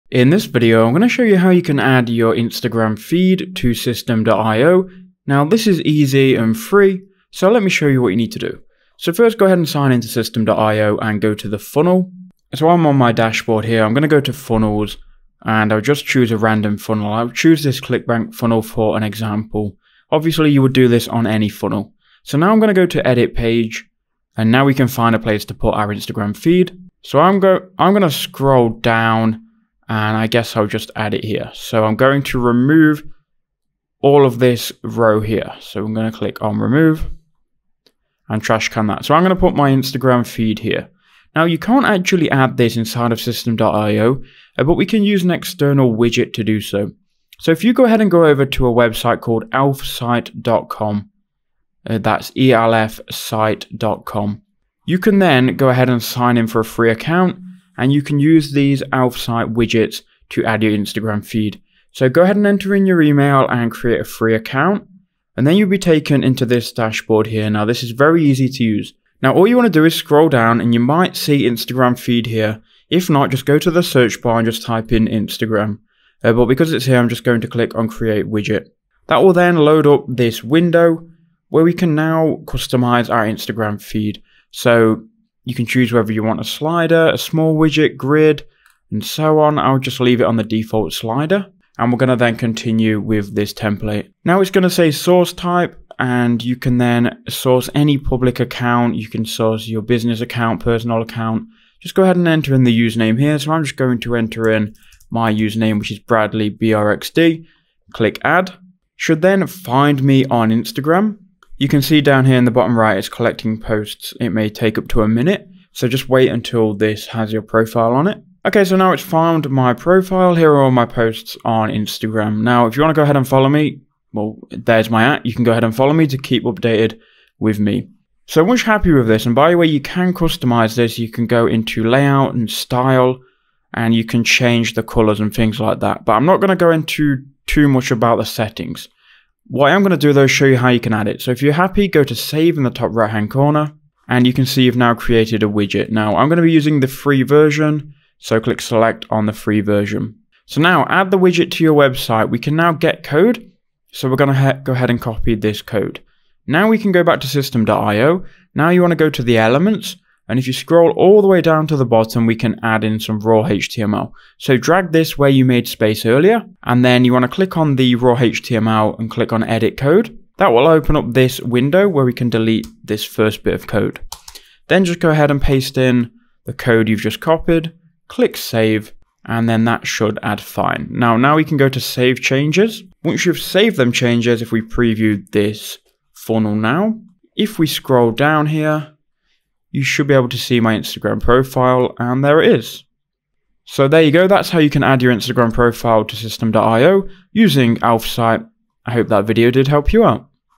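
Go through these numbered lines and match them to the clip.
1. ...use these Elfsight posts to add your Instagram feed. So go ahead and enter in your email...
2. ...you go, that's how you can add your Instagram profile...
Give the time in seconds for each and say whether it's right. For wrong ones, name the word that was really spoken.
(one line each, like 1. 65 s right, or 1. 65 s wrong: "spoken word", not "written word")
1. 58 s wrong: "widgets", not "posts"
2. 194 s right.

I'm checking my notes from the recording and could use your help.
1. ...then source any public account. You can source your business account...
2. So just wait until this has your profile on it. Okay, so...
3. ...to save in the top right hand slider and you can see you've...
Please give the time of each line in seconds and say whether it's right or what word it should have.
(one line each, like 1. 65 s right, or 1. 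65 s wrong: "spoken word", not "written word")
1. 96 s right
2. 115 s right
3. 142 s wrong: "corner", not "slider".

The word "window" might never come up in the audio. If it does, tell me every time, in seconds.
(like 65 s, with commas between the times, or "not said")
80 s, 171 s.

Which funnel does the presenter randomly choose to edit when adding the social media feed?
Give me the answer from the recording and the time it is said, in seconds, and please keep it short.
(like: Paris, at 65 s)
ClickBank funnel, at 17 s.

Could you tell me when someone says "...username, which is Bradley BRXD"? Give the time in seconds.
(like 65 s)
105 s.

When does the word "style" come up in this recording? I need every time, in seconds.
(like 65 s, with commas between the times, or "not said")
132 s.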